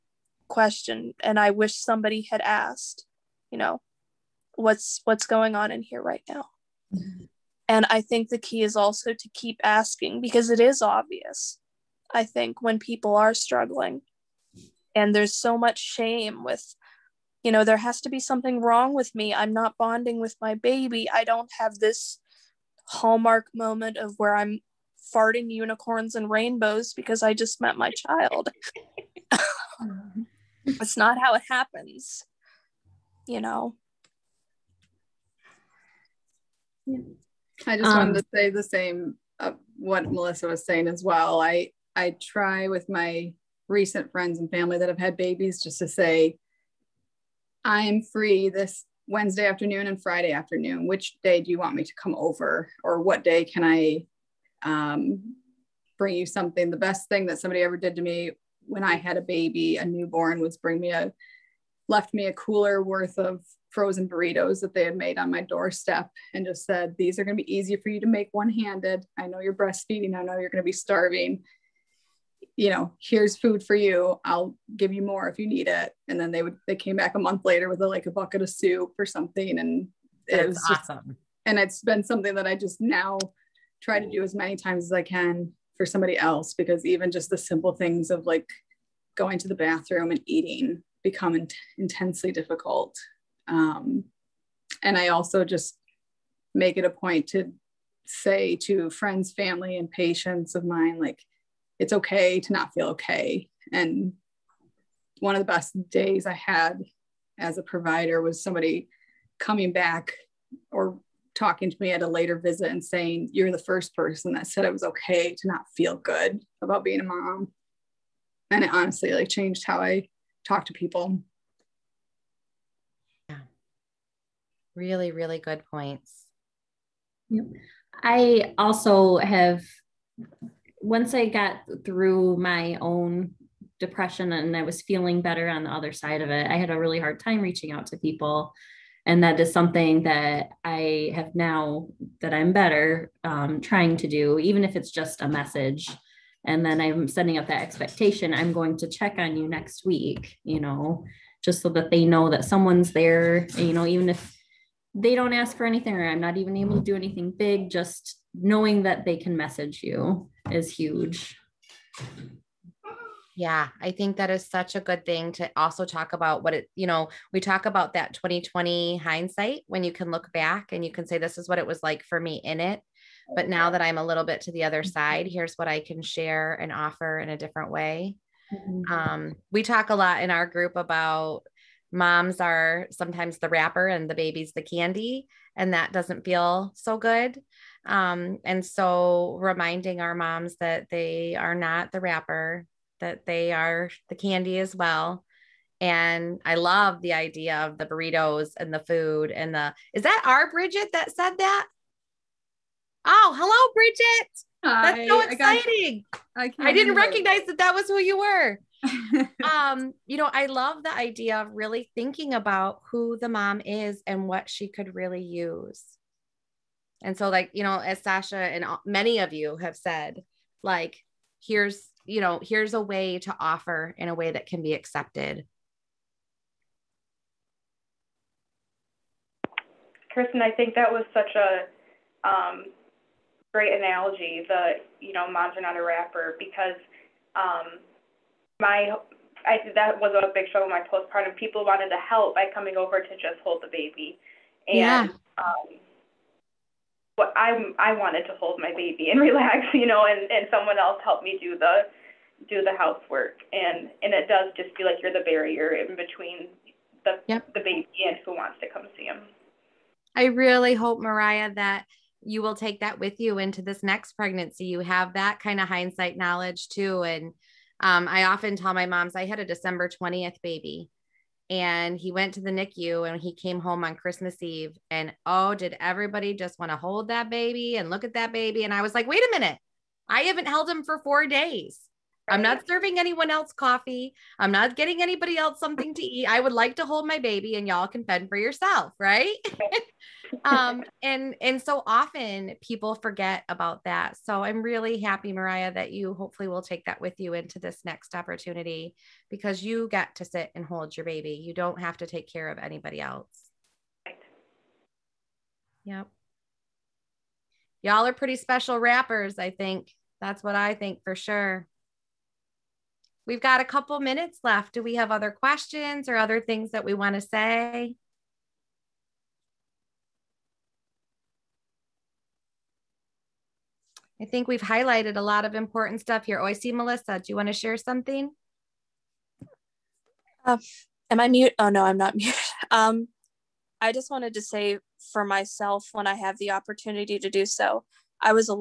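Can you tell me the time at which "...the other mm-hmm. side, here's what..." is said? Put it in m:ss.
2:54.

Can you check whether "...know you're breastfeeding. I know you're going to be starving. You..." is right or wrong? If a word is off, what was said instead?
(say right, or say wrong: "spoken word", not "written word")
right.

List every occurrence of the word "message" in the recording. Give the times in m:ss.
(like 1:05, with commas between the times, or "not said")
2:25, 2:39.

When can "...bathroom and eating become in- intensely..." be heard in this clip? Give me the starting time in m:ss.
1:29.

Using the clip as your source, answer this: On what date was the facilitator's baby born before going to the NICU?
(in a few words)
December 20th.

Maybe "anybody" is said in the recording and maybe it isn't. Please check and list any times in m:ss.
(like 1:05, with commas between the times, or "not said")
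4:45, 5:02.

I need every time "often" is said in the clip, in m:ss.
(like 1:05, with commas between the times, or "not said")
4:28, 4:51.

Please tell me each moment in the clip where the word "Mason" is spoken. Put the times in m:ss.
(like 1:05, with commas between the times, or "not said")
not said.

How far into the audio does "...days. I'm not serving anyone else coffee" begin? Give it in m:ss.
4:41.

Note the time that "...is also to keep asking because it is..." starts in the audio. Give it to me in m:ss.
0:08.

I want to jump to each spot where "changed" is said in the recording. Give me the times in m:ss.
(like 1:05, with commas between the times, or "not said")
1:59.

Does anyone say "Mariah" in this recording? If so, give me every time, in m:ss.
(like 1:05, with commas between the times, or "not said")
4:20, 4:55.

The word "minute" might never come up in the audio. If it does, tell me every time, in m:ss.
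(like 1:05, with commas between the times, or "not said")
4:39, 5:14.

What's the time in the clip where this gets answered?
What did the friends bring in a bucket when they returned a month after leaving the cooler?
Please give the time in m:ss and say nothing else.
1:18.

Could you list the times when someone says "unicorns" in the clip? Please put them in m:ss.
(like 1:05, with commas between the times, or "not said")
0:25.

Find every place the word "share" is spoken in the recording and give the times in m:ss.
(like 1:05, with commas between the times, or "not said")
2:56, 5:27.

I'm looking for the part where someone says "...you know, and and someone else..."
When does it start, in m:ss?
4:09.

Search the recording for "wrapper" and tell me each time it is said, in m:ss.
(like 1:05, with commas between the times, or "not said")
3:03, 3:12, 3:55, 5:08.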